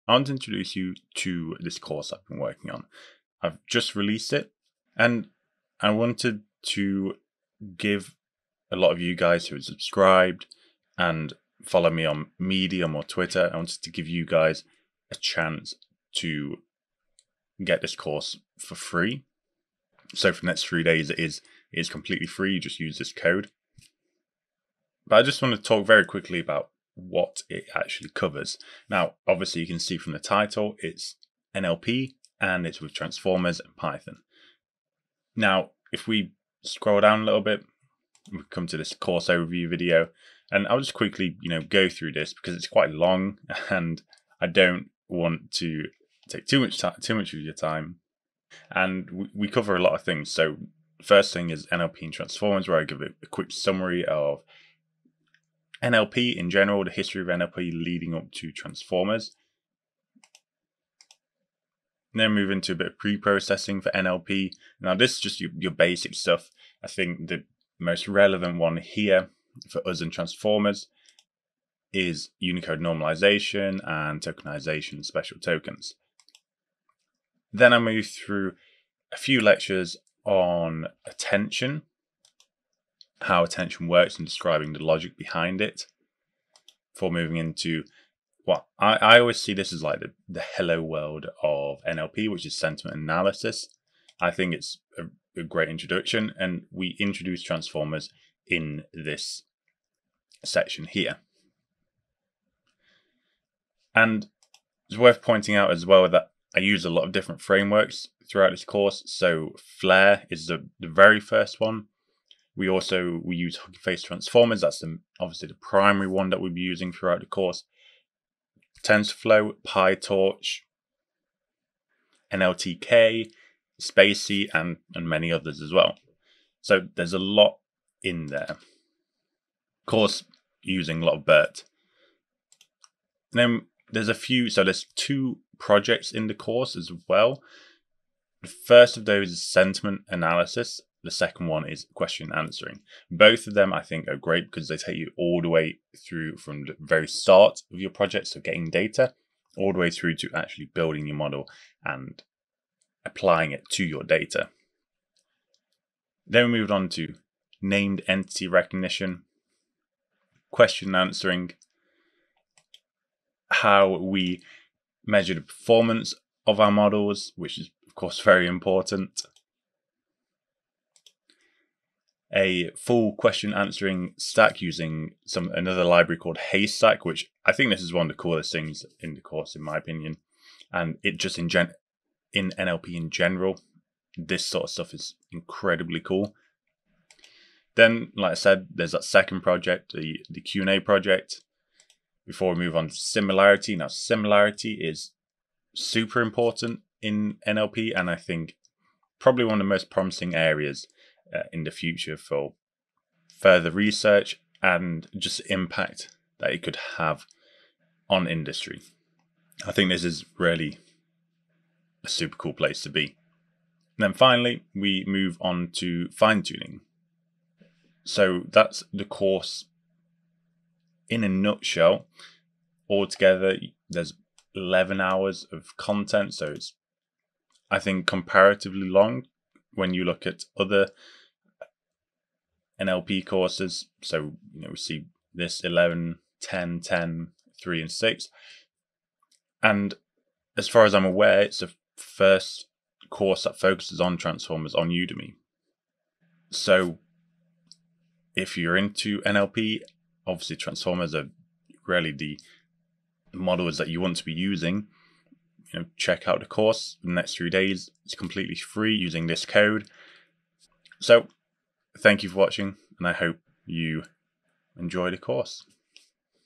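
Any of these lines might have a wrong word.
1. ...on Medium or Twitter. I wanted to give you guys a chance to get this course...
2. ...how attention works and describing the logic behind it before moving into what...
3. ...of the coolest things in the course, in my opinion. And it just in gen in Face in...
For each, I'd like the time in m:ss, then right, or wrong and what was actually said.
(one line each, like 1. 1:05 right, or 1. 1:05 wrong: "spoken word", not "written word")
1. 0:12 right
2. 1:23 right
3. 2:58 wrong: "NLP", not "Face".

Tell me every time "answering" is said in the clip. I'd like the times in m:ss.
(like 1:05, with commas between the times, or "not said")
2:22, 2:40, 2:53.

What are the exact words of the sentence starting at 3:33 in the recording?
And then finally, we move on to fine tuning.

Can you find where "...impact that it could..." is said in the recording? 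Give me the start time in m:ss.
3:25.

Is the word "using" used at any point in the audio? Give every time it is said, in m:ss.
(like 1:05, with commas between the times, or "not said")
1:56, 2:10, 2:54, 4:14, 4:18.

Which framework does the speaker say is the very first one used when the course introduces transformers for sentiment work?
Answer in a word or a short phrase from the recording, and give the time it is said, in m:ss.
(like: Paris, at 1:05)
Flair, at 1:49.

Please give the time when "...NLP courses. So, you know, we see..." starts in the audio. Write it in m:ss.
3:52.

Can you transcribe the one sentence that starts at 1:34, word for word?
I think it's a, a great introduction, and we introduce transformers in this section here.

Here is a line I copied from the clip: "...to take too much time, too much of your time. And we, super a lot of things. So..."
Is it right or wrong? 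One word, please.
wrong.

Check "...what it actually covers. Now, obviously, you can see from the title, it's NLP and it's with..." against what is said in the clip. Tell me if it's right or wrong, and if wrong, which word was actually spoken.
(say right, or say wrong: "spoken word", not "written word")
right.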